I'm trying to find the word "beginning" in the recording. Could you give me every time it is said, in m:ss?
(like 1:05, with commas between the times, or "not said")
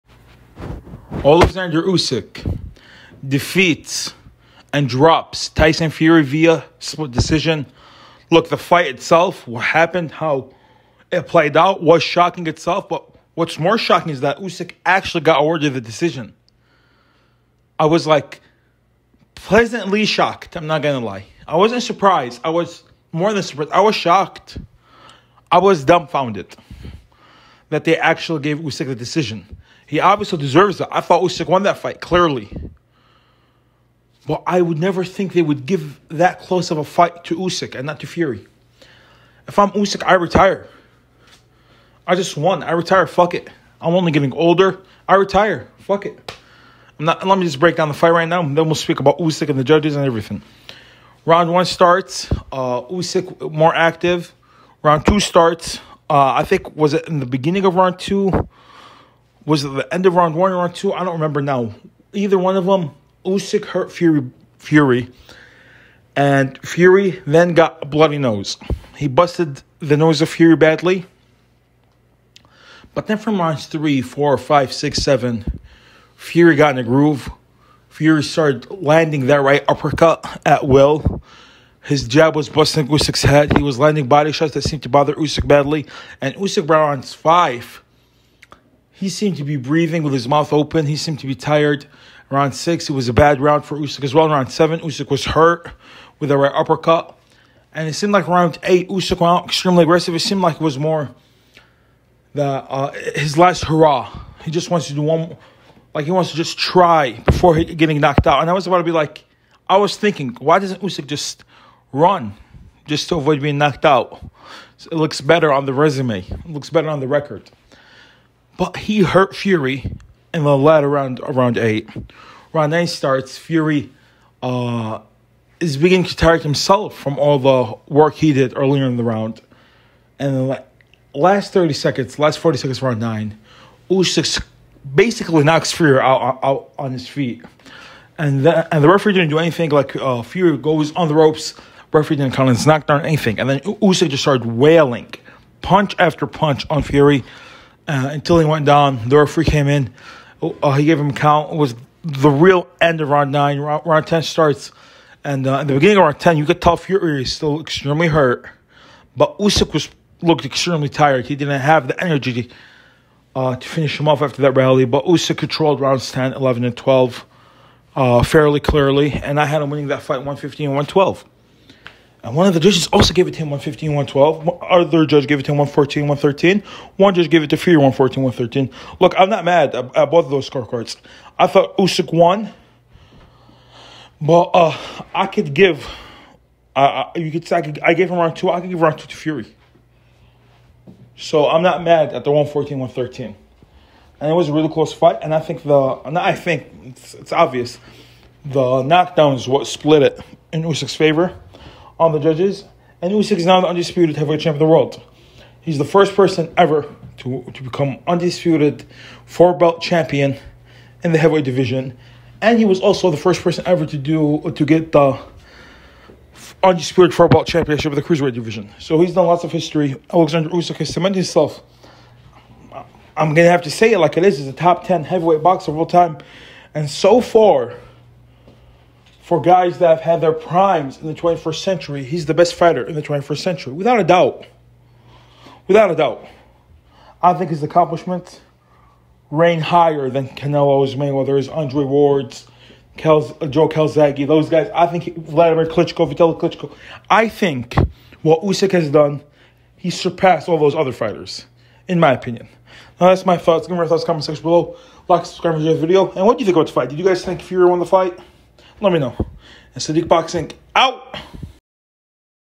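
0:57, 2:05, 2:35.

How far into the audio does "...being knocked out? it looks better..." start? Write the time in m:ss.
1:53.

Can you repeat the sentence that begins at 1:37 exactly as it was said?
And it seemed like round eight, Usyk went extremely aggressive.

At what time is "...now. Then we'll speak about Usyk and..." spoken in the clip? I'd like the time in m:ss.
0:48.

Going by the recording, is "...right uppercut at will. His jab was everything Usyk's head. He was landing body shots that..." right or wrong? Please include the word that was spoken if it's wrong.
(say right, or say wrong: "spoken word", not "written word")
wrong: "busting", not "everything".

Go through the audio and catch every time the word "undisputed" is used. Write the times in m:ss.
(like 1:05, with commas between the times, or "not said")
3:23, 3:28, 3:36.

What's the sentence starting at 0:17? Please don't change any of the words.
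I was like pleasantly shocked, I'm not gonna lie.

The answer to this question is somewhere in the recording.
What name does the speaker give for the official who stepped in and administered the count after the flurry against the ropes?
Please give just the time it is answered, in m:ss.
2:29.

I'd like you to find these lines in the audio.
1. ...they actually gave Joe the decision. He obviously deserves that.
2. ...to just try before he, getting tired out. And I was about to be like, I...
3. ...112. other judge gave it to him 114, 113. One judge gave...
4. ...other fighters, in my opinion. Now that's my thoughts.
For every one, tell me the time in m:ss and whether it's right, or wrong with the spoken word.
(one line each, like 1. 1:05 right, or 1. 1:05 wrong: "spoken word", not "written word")
1. 0:27 wrong: "Usyk", not "Joe"
2. 1:46 wrong: "knocked", not "tired"
3. 2:53 right
4. 4:10 right.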